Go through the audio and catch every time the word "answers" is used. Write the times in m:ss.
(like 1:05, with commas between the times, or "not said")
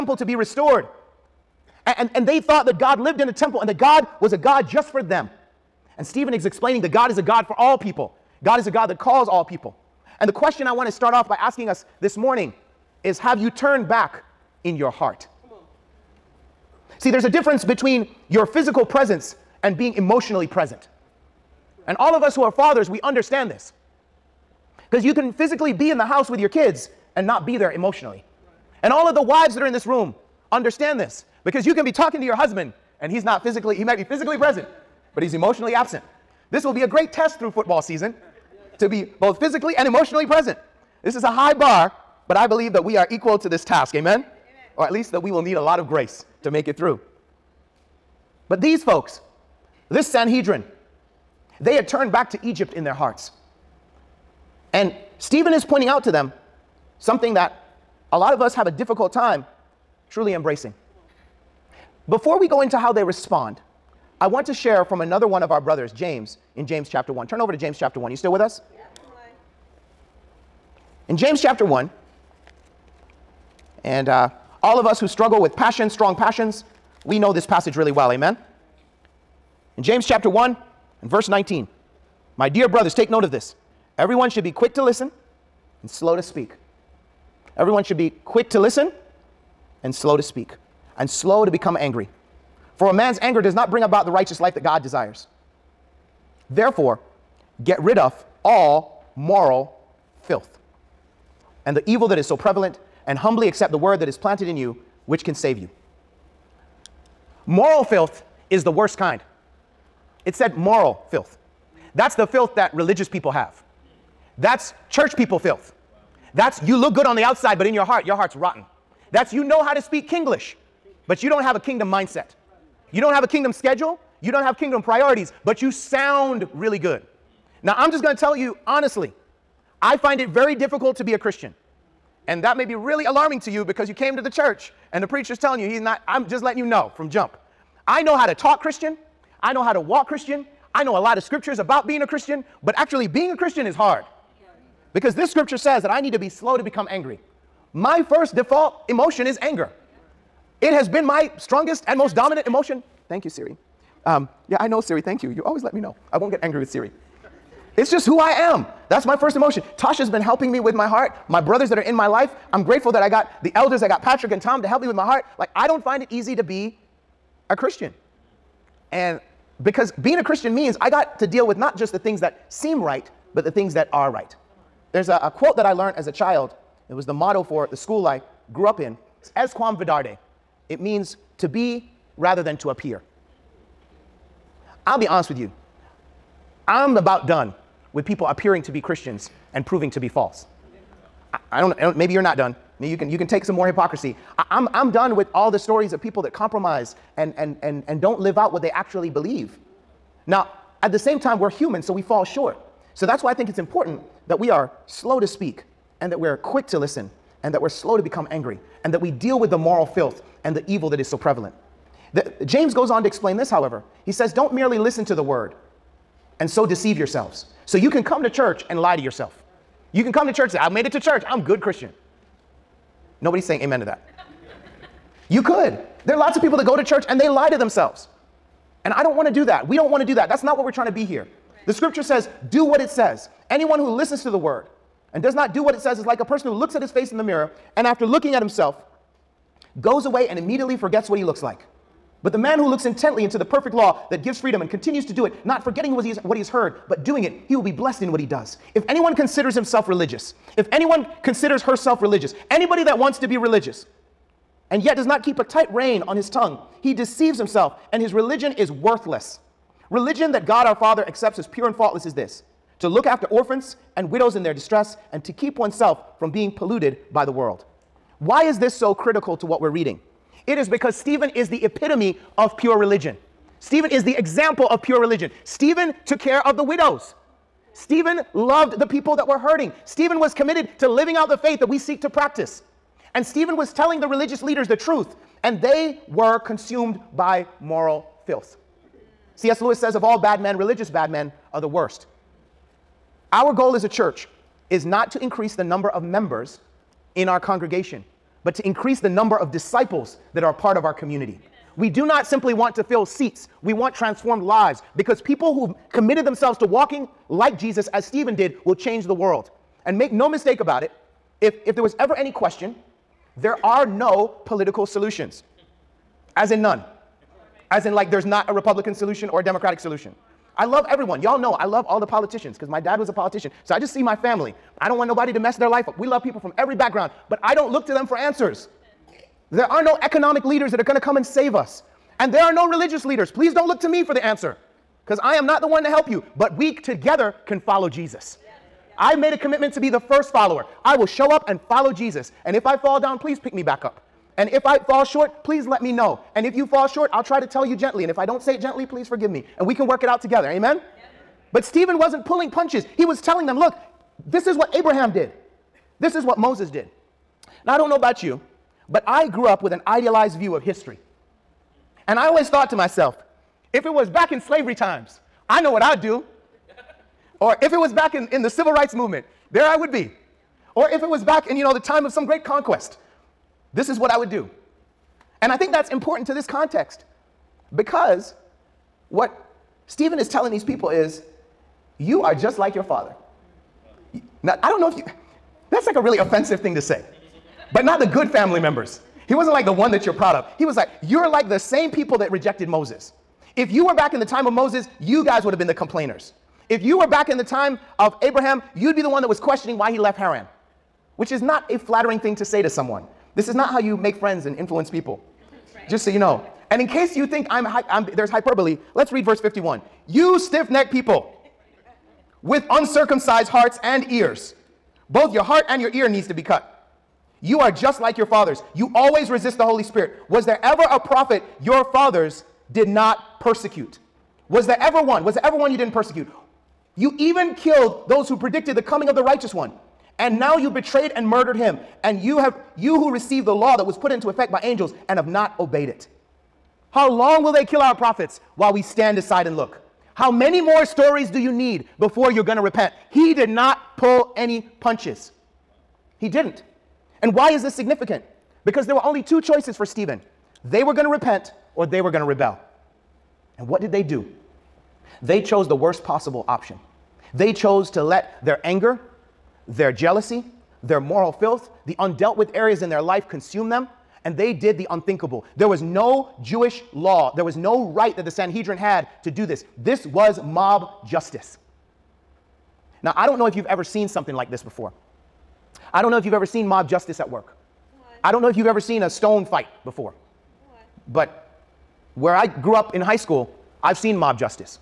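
5:28, 5:34.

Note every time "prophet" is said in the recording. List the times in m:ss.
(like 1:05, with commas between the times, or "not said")
7:00, 7:17.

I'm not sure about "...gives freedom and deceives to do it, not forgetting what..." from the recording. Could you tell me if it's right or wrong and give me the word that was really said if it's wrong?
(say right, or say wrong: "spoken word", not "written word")
wrong: "continues", not "deceives".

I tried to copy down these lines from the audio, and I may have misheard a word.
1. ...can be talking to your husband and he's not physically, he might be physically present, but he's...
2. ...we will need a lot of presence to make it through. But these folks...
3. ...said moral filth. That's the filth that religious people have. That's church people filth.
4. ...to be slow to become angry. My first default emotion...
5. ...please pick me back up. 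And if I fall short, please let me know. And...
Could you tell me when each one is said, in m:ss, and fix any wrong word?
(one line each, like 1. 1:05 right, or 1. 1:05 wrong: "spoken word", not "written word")
1. 0:31 right
2. 0:45 wrong: "grace", not "presence"
3. 1:50 right
4. 2:26 right
5. 5:43 right.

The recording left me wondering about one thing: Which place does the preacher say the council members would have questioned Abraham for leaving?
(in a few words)
Haran.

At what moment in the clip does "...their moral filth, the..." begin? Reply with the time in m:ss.
7:40.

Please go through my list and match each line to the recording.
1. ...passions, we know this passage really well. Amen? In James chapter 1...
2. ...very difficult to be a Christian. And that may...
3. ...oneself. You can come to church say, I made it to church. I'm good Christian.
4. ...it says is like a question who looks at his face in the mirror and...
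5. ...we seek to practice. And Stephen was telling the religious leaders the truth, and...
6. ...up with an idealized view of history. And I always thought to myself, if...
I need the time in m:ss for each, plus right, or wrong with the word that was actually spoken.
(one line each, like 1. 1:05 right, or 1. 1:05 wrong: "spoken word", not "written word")
1. 1:16 right
2. 2:10 right
3. 3:39 wrong: "yourself", not "oneself"
4. 3:55 wrong: "person", not "question"
5. 4:41 right
6. 5:59 right.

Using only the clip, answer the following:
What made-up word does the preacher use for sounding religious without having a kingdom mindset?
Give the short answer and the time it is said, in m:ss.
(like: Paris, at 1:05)
Kinglish, at 2:00.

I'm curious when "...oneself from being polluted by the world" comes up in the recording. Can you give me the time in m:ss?
4:25.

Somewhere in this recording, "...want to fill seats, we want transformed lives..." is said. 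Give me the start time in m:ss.
5:02.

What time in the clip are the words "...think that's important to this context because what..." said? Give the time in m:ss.
6:15.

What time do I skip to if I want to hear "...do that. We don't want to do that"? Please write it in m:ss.
3:49.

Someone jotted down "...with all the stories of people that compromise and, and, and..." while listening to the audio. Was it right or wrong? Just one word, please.
right.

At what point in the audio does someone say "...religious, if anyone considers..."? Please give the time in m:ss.
4:09.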